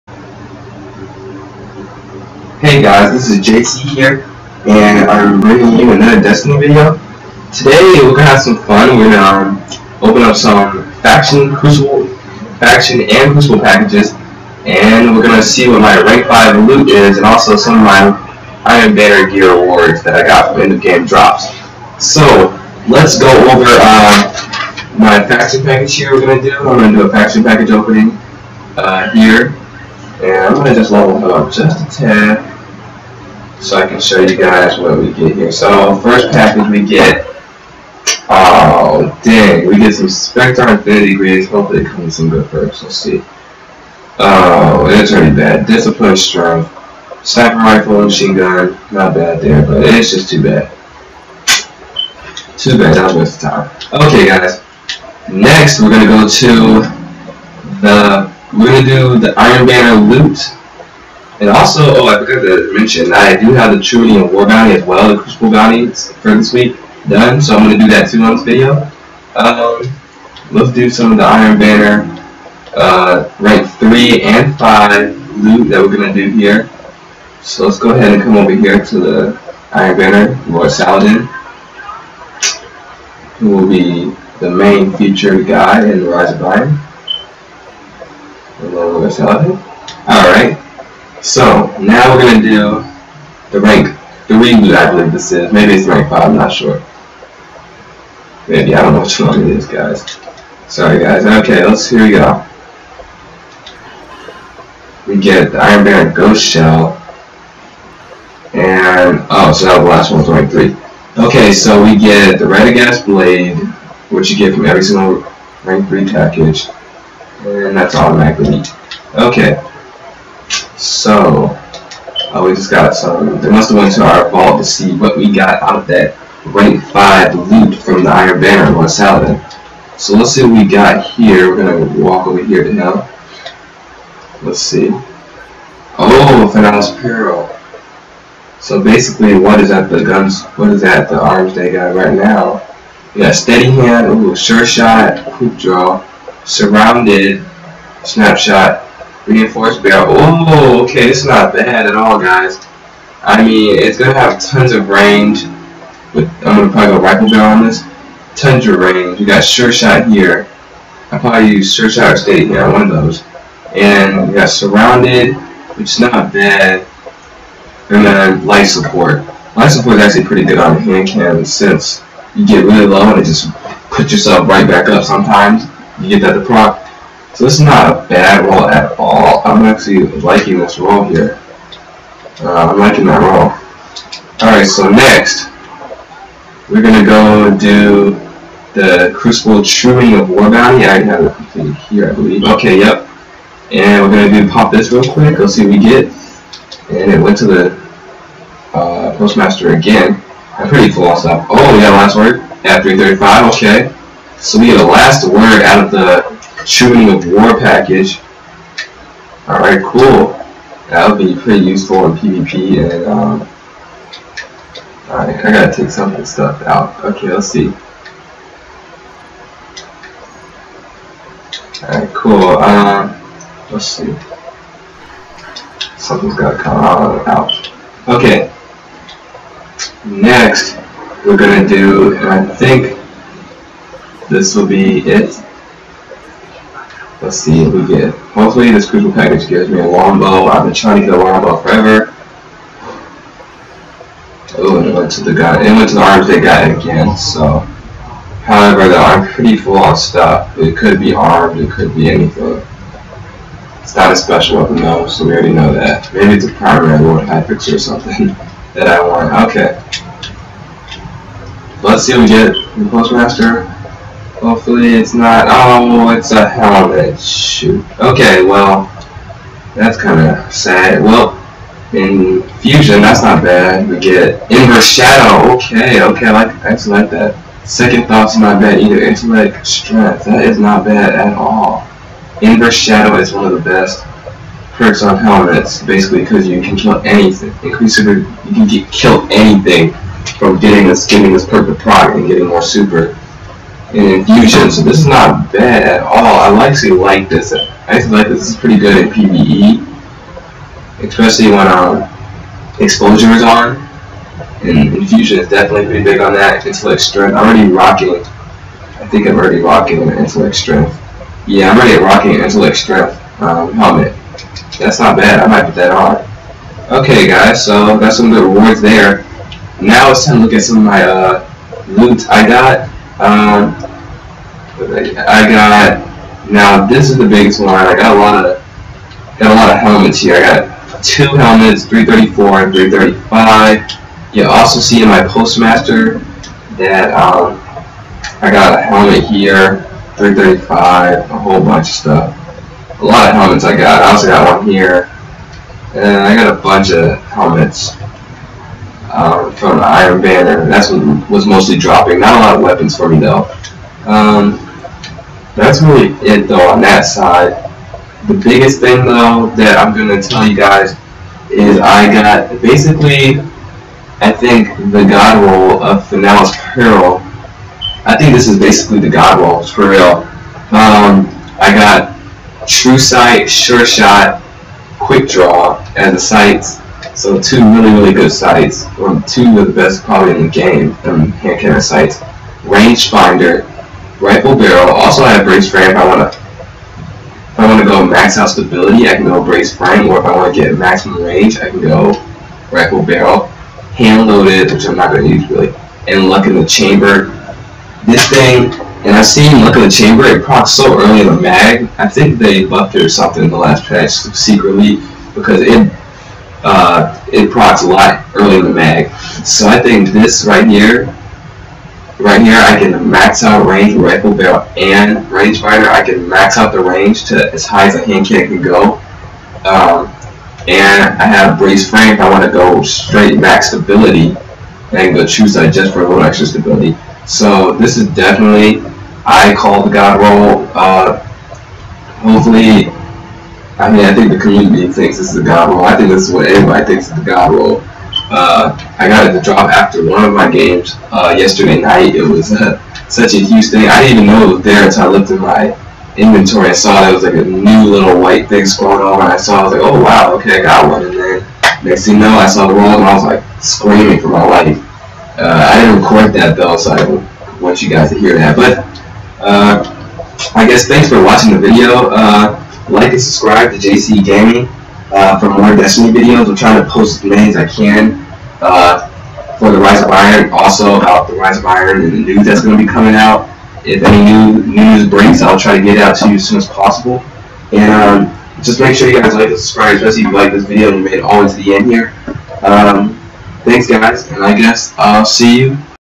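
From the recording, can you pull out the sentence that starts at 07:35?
Uh, I didn't record that though, so I want you guys to hear that.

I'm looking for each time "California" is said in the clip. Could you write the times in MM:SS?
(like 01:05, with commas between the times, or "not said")
not said.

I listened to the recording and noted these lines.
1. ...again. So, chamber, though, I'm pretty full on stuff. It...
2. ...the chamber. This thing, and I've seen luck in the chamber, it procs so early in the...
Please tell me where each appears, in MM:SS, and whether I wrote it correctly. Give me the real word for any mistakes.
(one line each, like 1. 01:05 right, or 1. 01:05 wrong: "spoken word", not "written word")
1. 04:06 wrong: "however", not "chamber"
2. 06:36 right.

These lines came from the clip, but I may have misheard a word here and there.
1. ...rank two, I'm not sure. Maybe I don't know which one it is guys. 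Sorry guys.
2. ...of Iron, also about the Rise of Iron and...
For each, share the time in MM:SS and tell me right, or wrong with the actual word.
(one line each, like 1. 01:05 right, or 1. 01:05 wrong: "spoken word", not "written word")
1. 01:35 wrong: "five", not "two"
2. 07:50 right.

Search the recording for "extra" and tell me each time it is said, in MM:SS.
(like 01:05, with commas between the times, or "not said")
07:06.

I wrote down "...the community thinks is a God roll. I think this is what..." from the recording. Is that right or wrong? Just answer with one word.
right.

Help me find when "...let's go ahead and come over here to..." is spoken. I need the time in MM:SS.
01:17.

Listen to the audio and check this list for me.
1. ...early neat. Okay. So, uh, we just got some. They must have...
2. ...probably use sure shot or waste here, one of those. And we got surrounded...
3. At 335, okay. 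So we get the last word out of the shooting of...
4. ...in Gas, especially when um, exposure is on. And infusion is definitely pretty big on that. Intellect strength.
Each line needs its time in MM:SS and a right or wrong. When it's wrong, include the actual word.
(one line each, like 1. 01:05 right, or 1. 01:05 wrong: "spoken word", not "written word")
1. 01:57 wrong: "automatically", not "early"
2. 02:41 wrong: "state", not "waste"
3. 03:22 right
4. 04:59 wrong: "PvE", not "Gas".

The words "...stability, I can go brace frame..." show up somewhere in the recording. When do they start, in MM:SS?
06:28.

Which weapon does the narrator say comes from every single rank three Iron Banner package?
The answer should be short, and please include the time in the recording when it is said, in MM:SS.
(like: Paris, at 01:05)
Gas Blade, at 01:52.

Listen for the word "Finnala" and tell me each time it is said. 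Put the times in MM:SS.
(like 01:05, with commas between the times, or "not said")
02:16, 06:06.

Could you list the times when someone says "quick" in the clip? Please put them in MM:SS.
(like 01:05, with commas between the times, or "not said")
02:25, 03:15, 06:14.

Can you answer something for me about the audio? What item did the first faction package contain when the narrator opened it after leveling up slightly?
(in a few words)
Spectre Infinity Grids.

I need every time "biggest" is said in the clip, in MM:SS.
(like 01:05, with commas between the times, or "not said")
05:27, 05:58.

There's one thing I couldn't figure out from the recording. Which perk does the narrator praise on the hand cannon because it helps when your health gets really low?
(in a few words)
Light support.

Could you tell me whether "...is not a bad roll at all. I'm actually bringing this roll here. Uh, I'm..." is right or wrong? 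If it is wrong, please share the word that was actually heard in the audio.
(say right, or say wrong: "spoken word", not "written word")
wrong: "liking", not "bringing".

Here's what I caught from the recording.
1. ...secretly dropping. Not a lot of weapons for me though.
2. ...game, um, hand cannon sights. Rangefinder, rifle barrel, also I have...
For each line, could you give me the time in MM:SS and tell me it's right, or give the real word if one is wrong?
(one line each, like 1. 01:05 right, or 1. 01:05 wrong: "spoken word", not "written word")
1. 05:51 wrong: "mostly", not "secretly"
2. 06:20 right.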